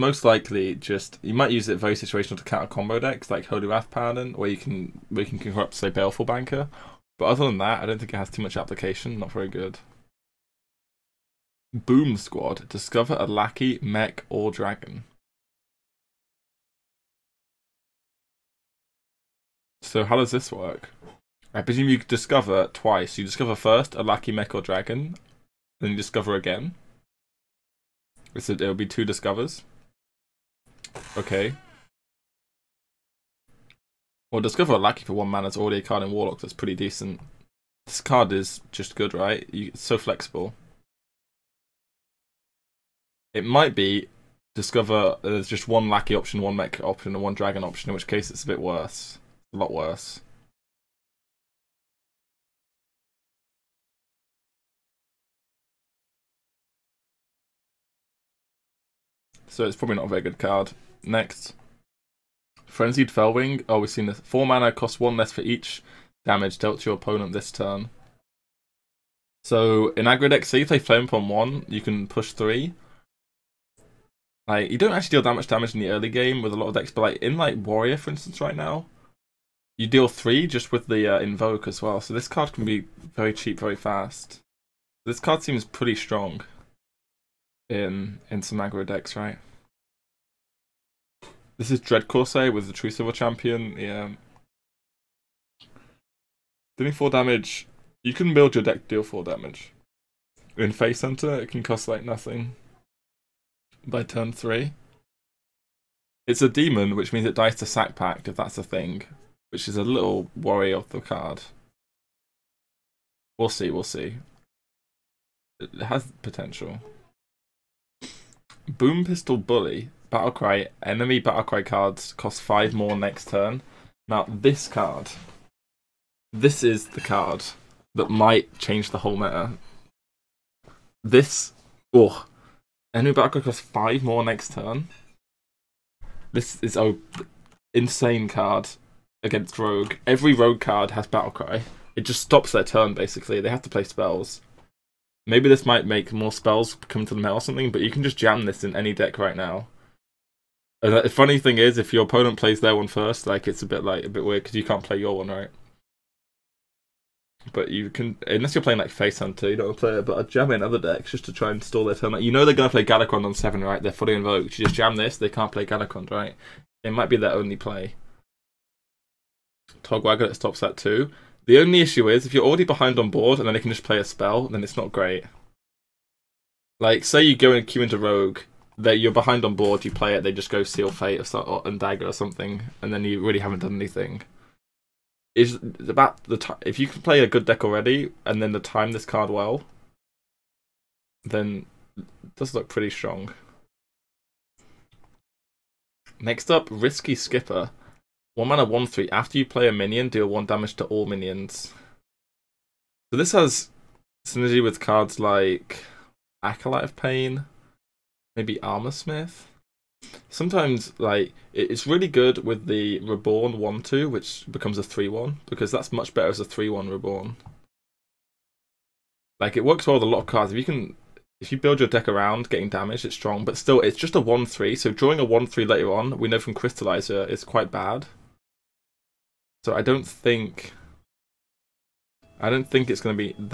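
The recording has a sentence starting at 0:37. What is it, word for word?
This card is just good, right?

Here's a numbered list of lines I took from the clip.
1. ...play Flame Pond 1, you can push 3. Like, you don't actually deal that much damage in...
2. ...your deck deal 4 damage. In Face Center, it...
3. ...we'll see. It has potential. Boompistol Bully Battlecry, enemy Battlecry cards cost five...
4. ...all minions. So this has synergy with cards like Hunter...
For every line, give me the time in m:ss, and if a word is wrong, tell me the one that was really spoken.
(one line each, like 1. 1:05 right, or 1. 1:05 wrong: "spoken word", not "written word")
1. 1:10 right
2. 1:38 right
3. 1:53 right
4. 3:20 wrong: "Acolyte", not "Hunter".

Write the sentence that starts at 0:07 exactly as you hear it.
But other than that, I don't think it has too much application.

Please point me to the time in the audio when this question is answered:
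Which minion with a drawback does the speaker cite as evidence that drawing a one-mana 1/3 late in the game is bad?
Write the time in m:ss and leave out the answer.
3:46.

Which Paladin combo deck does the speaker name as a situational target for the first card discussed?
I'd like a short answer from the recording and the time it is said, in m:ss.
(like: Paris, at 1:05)
Holy Wrath Paladin, at 0:03.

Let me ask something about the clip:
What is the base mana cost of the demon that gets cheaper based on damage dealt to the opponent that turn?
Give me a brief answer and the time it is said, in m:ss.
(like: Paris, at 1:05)
4, at 1:04.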